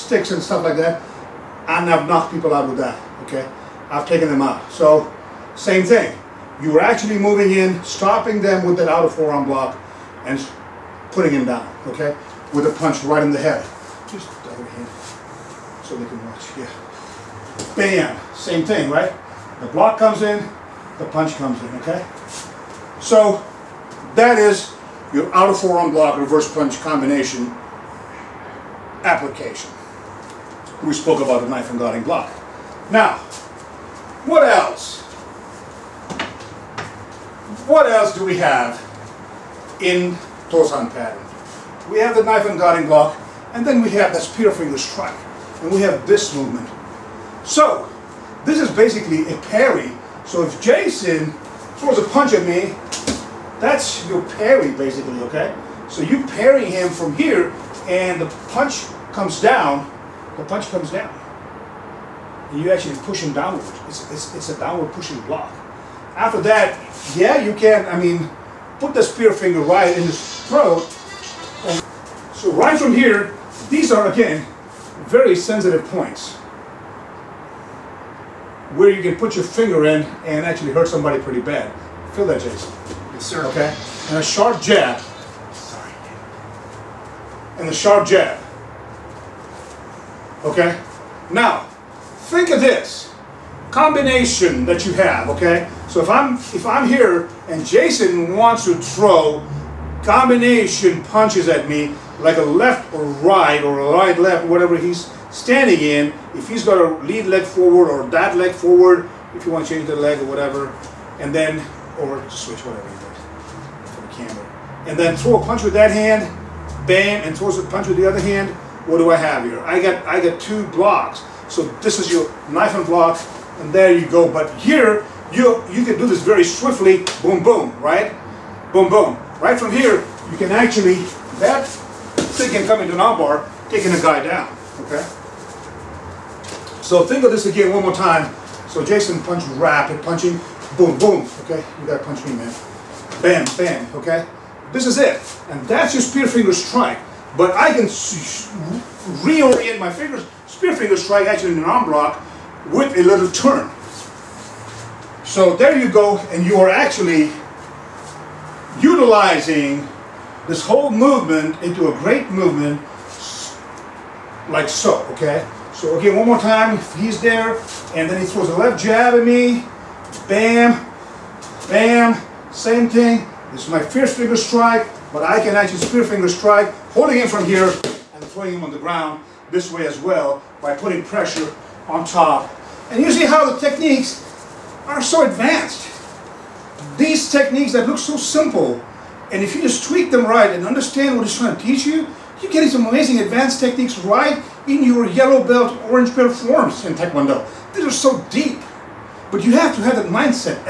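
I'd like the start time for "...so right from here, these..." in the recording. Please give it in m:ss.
1:12.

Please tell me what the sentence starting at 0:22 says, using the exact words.
So, that is your outer forearm block reverse punch combination application.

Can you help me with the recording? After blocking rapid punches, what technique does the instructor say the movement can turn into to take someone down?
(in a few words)
armbar.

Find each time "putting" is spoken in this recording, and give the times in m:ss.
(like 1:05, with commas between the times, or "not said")
0:11, 3:00.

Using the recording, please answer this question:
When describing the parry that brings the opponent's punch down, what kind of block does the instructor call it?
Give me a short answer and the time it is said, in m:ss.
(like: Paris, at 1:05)
downward pushing block, at 1:04.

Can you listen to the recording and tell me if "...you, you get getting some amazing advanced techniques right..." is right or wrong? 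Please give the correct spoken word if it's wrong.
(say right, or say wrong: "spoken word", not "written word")
right.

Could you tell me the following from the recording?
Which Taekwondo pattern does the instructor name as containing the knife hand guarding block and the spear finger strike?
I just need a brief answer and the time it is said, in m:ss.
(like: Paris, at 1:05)
Tosan, at 0:40.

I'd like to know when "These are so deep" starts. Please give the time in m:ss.
3:17.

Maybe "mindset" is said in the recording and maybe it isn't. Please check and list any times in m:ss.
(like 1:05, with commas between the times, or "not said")
3:20.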